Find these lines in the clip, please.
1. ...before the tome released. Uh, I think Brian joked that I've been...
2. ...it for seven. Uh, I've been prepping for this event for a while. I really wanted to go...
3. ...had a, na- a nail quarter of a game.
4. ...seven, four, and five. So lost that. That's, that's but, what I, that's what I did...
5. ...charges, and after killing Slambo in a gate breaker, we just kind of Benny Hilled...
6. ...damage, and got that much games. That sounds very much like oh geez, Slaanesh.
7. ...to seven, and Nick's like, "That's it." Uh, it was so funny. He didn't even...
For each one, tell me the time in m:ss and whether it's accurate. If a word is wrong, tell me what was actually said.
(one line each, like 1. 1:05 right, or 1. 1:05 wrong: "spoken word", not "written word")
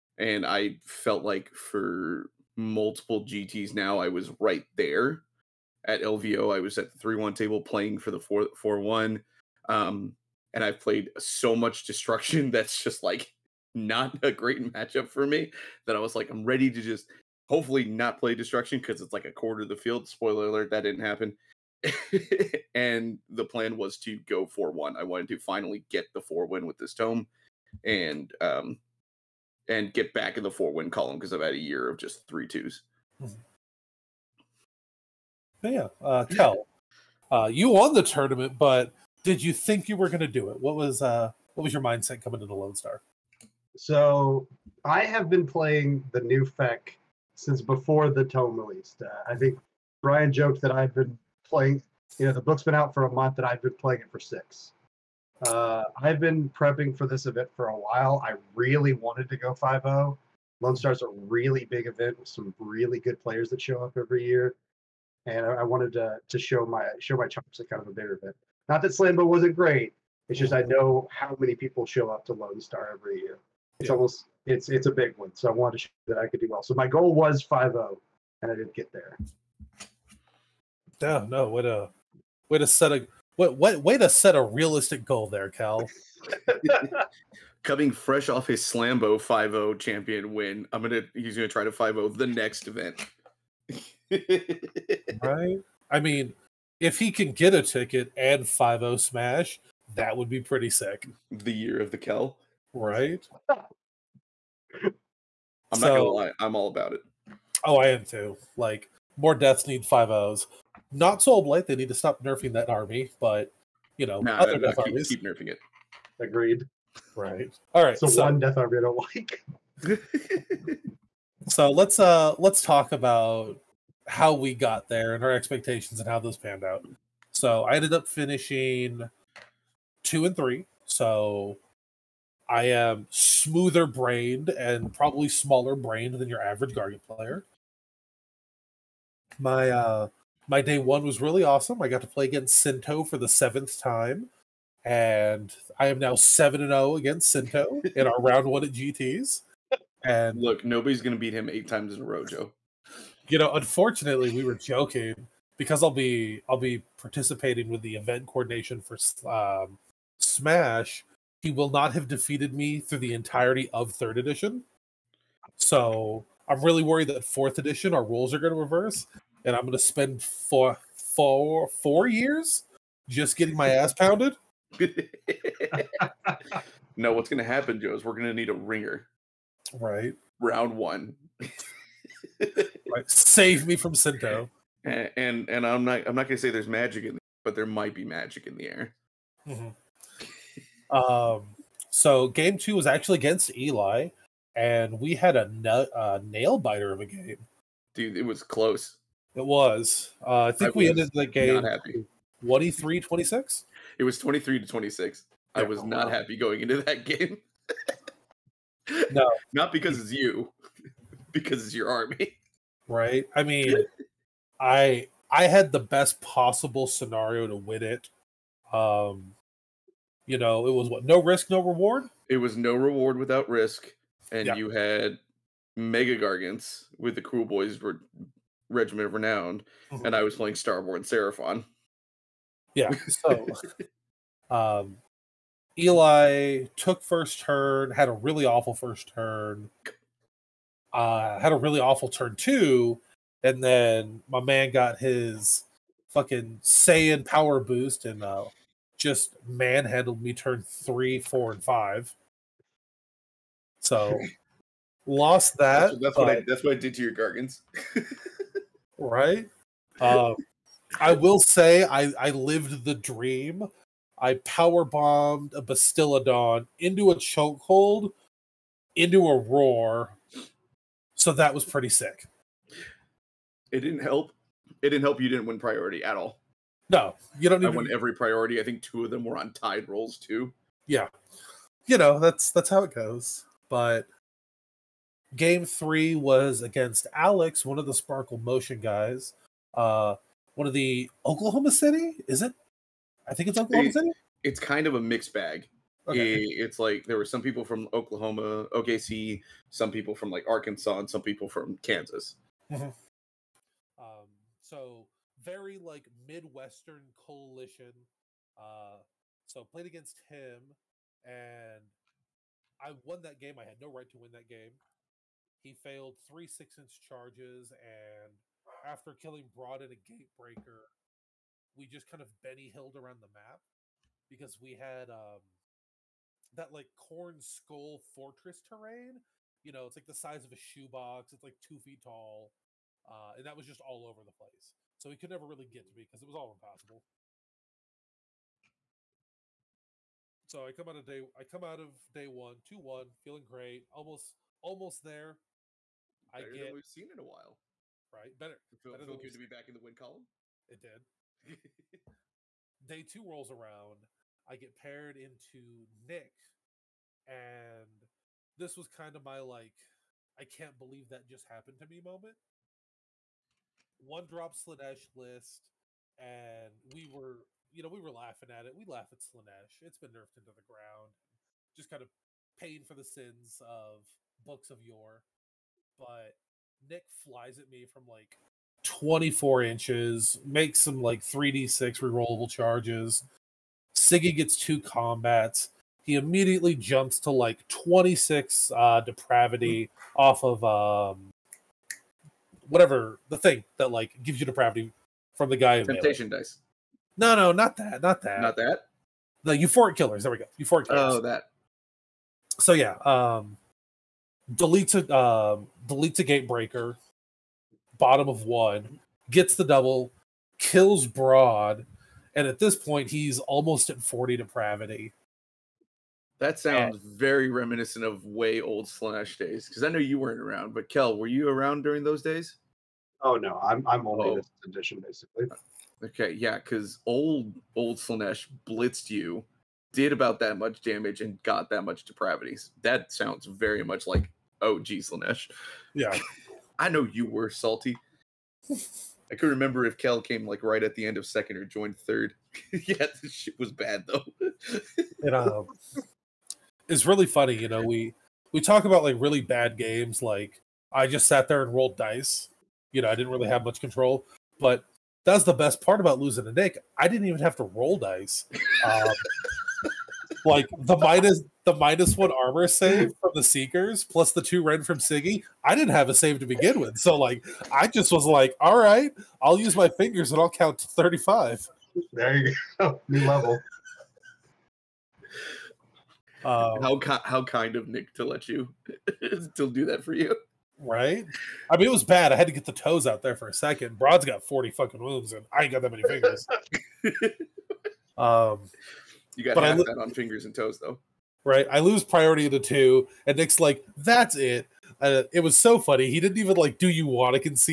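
1. 0:47 right
2. 0:54 wrong: "six", not "seven"
3. 3:15 wrong: "biter", not "quarter"
4. 4:10 wrong: "three", not "seven"
5. 5:16 wrong: "Broad", not "Slambo"
6. 7:10 wrong: "depravities", not "games"
7. 8:12 wrong: "two", not "seven".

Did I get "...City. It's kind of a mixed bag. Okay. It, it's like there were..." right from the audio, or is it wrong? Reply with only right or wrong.
right.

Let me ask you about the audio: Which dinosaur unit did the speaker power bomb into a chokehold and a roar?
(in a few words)
Bastiladon.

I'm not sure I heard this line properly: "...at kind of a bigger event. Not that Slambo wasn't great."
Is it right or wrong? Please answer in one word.
right.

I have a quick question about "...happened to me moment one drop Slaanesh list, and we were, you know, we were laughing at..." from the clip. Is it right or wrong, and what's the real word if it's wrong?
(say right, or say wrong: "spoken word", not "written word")
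right.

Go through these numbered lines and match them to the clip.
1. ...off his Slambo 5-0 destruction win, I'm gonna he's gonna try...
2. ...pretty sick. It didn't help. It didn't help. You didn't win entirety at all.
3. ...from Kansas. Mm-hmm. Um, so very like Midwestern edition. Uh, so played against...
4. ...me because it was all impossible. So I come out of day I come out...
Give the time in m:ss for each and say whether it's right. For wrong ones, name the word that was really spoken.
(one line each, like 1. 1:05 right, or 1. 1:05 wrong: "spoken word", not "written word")
1. 1:28 wrong: "champion", not "destruction"
2. 4:31 wrong: "priority", not "entirety"
3. 5:01 wrong: "coalition", not "edition"
4. 5:35 right.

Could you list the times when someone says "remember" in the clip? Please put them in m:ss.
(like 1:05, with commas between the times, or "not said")
7:19.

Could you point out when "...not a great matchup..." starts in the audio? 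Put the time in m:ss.
0:13.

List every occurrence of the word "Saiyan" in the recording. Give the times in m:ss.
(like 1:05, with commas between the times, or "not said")
4:06.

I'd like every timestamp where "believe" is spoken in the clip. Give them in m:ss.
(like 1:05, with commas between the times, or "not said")
6:00.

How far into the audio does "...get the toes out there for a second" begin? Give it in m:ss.
8:02.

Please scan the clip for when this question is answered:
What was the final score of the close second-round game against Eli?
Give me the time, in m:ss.
3:24.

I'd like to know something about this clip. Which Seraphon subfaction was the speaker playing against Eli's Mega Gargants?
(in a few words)
Starborn.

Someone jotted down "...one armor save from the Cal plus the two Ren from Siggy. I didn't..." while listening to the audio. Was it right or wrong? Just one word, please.
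wrong.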